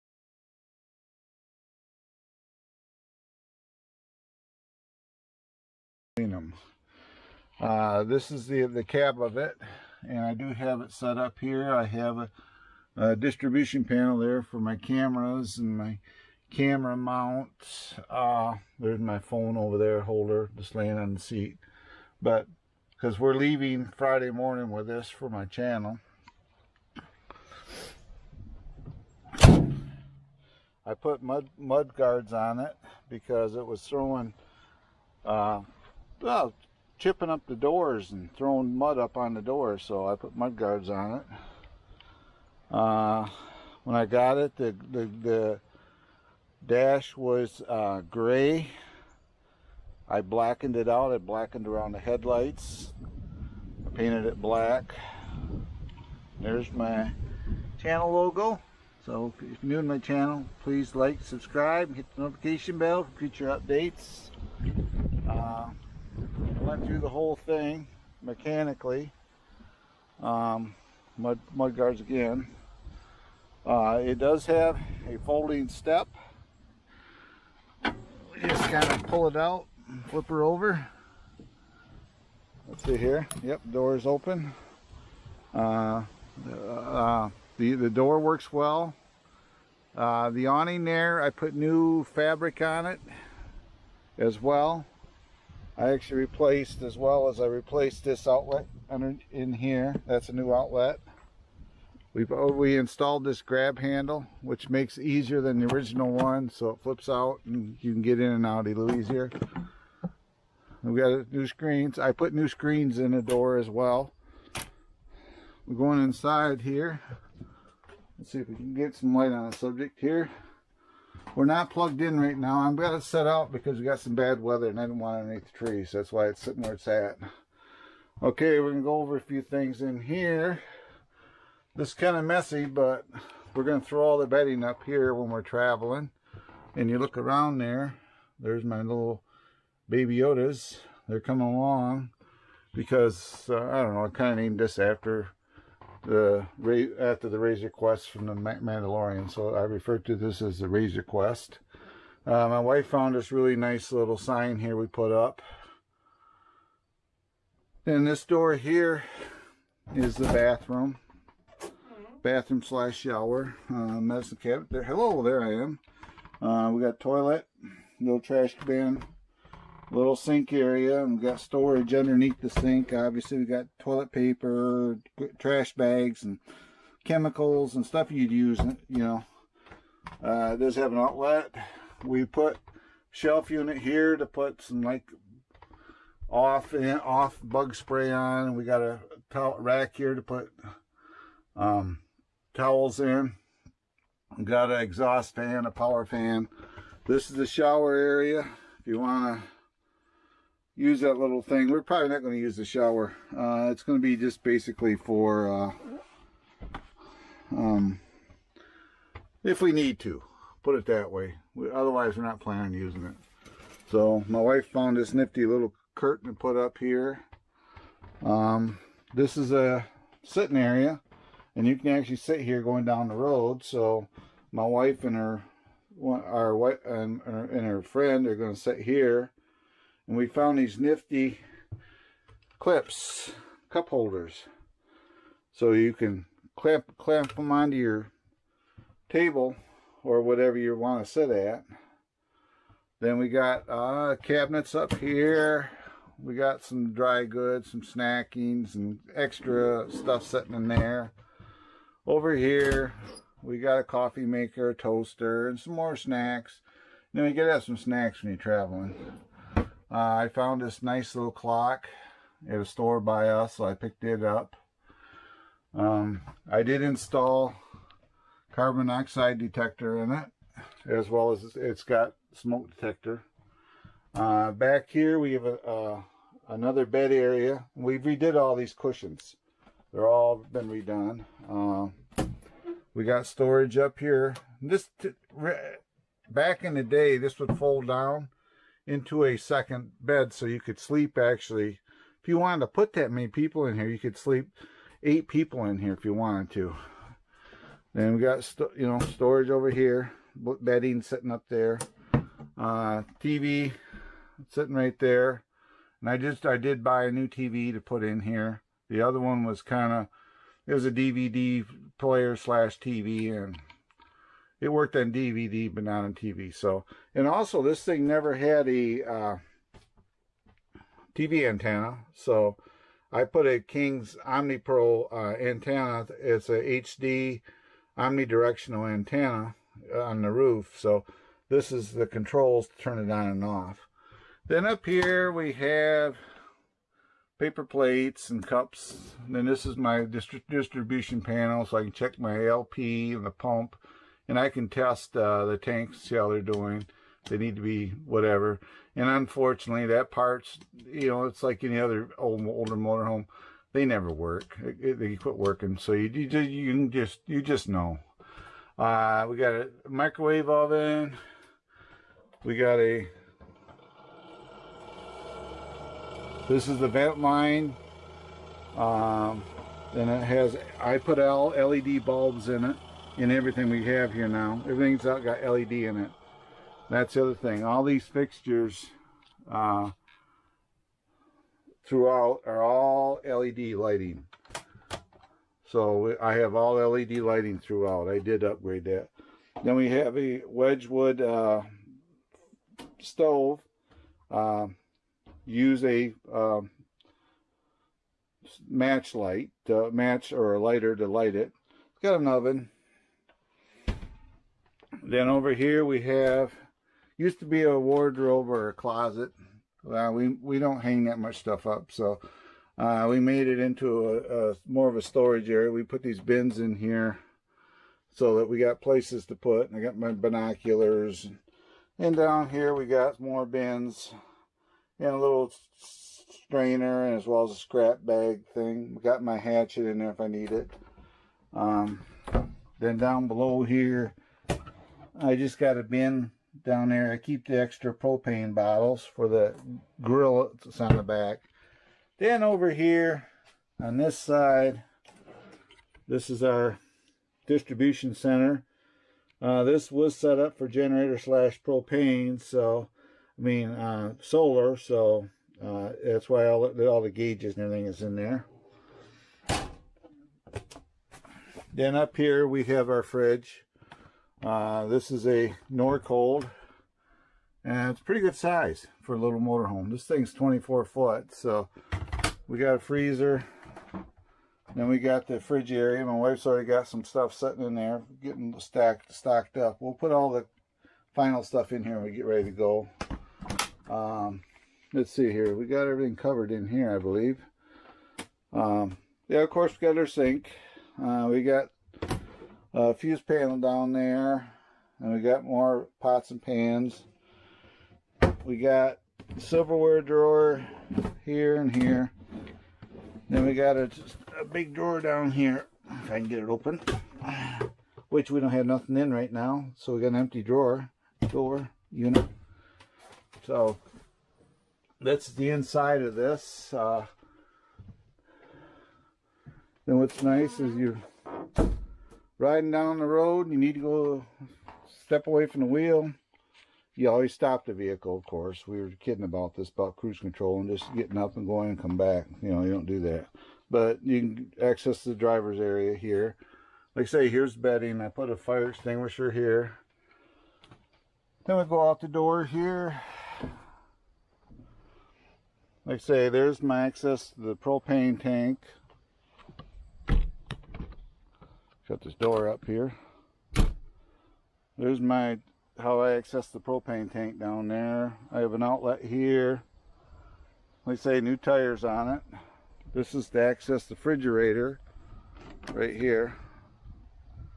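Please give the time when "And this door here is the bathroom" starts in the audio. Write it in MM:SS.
02:37.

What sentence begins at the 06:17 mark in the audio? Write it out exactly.
All these fixtures uh, throughout are all LED lighting.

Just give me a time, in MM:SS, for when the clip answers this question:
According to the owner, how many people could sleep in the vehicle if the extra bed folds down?
04:55.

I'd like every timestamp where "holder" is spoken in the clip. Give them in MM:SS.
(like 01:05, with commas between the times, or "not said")
00:20, 03:53.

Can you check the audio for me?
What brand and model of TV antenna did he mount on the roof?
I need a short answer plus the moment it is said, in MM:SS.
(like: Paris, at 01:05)
King's OmniPro, at 05:23.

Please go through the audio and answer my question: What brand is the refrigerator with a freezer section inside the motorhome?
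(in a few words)
Norcold.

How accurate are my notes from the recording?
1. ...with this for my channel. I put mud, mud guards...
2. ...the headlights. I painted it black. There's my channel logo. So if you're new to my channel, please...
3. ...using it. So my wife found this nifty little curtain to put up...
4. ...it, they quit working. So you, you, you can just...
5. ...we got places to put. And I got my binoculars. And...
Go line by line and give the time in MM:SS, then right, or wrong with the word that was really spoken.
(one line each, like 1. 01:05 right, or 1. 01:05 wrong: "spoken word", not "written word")
1. 00:24 right
2. 00:51 right
3. 03:32 right
4. 05:54 right
5. 06:58 right.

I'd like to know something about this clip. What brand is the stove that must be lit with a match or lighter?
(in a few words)
Wedgewood.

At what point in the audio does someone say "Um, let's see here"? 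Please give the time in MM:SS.
08:03.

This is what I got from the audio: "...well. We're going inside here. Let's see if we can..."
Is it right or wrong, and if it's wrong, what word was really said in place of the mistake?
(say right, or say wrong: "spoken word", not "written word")
right.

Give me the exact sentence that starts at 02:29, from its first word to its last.
So I refer to this as the Razor Crest.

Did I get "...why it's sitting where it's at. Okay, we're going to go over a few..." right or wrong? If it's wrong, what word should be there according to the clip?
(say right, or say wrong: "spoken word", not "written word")
right.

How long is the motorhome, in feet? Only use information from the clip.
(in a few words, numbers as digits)
24 foot.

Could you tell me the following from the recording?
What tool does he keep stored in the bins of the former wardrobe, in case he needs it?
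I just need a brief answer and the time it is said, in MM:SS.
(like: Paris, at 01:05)
Hatchet, at 07:09.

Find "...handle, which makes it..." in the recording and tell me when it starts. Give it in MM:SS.
01:43.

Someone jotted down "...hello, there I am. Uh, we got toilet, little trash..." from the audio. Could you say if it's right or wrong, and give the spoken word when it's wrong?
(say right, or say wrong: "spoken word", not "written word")
right.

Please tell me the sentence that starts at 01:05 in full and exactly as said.
Uh, I went through the whole thing mechanically.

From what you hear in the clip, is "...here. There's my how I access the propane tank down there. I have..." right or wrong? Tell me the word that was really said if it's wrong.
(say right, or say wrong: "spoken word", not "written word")
right.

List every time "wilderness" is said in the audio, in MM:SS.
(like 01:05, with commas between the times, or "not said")
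not said.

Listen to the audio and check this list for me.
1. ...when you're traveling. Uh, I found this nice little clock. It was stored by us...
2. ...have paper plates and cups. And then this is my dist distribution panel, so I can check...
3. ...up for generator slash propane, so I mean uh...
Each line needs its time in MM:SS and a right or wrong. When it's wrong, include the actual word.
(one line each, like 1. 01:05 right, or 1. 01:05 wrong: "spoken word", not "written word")
1. 04:18 right
2. 05:35 right
3. 07:30 right.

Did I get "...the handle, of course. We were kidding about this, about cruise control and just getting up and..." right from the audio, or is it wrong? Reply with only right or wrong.
wrong.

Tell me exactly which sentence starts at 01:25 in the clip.
Uh, uh, the, the door works well.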